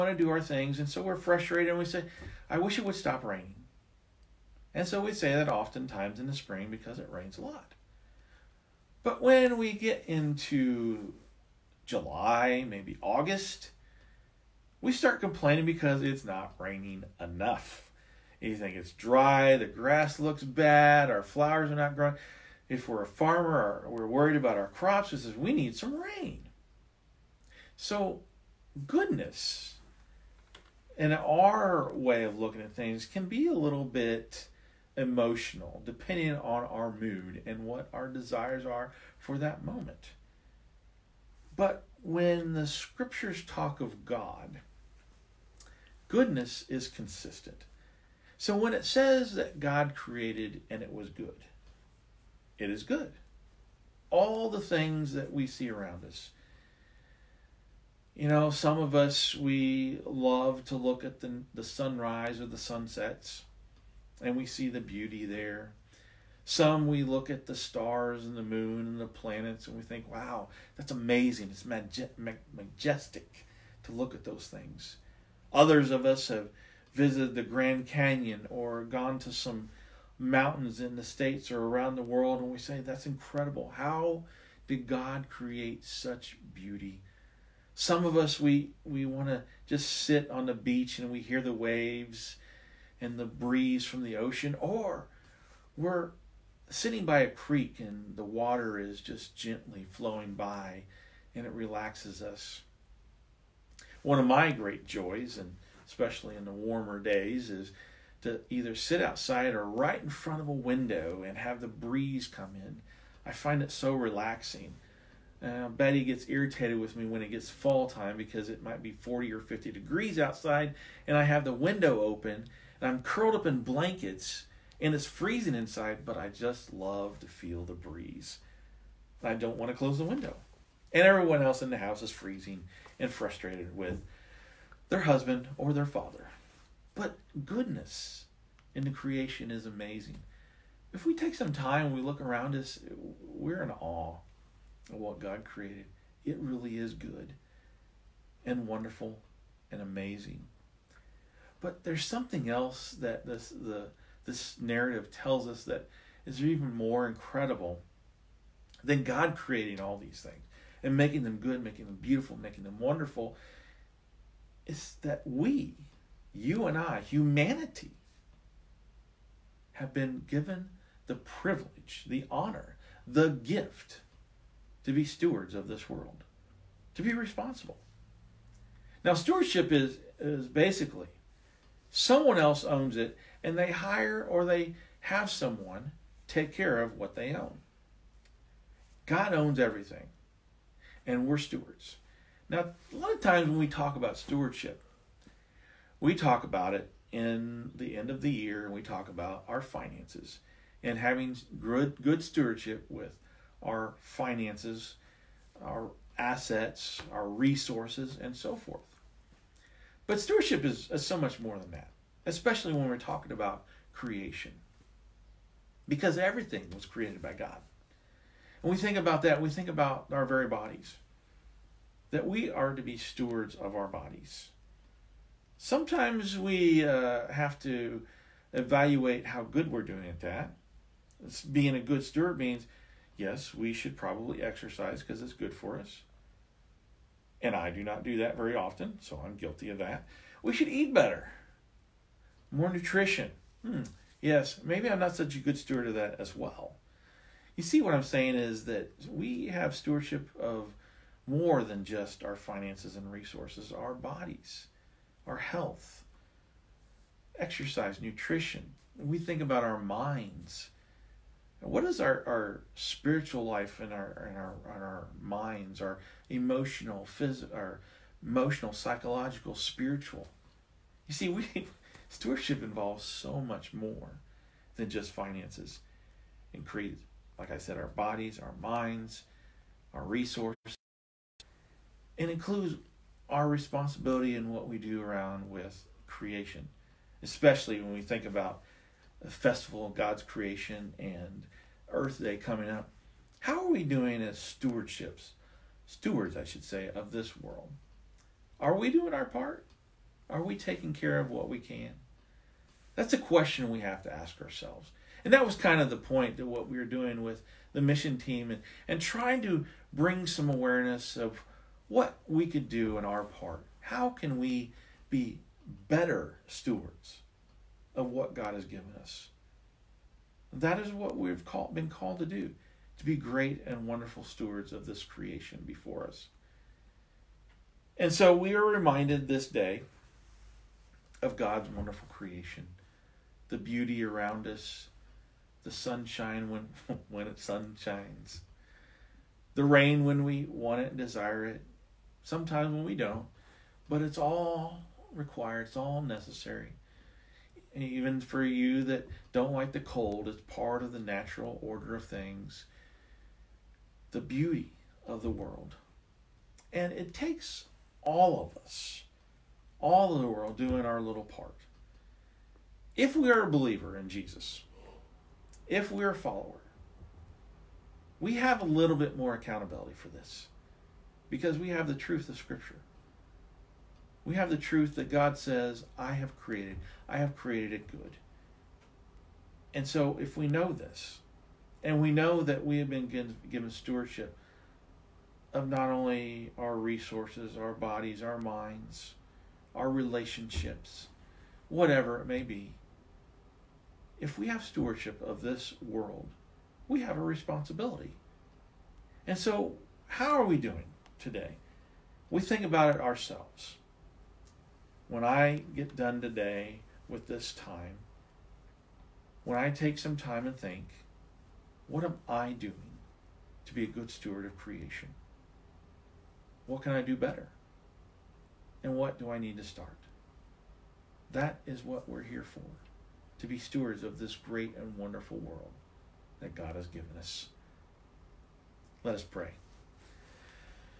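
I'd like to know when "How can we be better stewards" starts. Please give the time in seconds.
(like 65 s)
313 s.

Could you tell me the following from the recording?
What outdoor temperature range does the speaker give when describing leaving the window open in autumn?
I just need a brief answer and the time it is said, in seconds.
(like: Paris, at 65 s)
40 or 50 degrees, at 118 s.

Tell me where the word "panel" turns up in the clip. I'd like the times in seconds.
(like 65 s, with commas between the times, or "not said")
not said.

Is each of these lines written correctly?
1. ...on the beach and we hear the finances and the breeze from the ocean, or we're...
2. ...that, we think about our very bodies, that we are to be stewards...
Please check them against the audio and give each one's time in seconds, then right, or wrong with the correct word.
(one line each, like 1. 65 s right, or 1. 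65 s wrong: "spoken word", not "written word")
1. 90 s wrong: "waves", not "finances"
2. 219 s right.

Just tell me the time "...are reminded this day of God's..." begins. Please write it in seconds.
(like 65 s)
328 s.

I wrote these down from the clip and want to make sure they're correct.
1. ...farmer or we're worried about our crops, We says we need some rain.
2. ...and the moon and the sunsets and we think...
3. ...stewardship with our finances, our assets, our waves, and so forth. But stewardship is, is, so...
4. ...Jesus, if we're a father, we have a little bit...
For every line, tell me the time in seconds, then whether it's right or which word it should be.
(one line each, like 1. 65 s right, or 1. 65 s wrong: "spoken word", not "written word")
1. 23 s right
2. 68 s wrong: "planets", not "sunsets"
3. 202 s wrong: "resources", not "waves"
4. 364 s wrong: "follower", not "father".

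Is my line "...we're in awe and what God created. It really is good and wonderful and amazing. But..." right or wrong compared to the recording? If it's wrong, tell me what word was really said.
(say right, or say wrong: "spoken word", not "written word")
right.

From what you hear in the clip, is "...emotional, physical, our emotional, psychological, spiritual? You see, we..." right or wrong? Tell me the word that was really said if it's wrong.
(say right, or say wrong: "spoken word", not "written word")
right.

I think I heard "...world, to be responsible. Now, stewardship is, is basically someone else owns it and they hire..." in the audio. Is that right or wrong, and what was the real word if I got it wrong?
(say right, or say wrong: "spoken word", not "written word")
right.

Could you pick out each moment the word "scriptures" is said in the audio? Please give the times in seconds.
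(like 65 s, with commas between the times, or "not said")
42 s, 372 s.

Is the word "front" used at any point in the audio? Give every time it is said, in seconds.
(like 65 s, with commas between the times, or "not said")
110 s.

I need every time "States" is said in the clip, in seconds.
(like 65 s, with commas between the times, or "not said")
81 s.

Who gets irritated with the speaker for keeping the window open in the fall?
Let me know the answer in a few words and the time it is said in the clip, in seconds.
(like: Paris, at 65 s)
Betty, at 115 s.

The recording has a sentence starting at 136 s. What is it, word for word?
But goodness in the creation is amazing.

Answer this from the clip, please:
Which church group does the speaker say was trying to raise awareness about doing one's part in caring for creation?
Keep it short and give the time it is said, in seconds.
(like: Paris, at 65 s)
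the mission team, at 307 s.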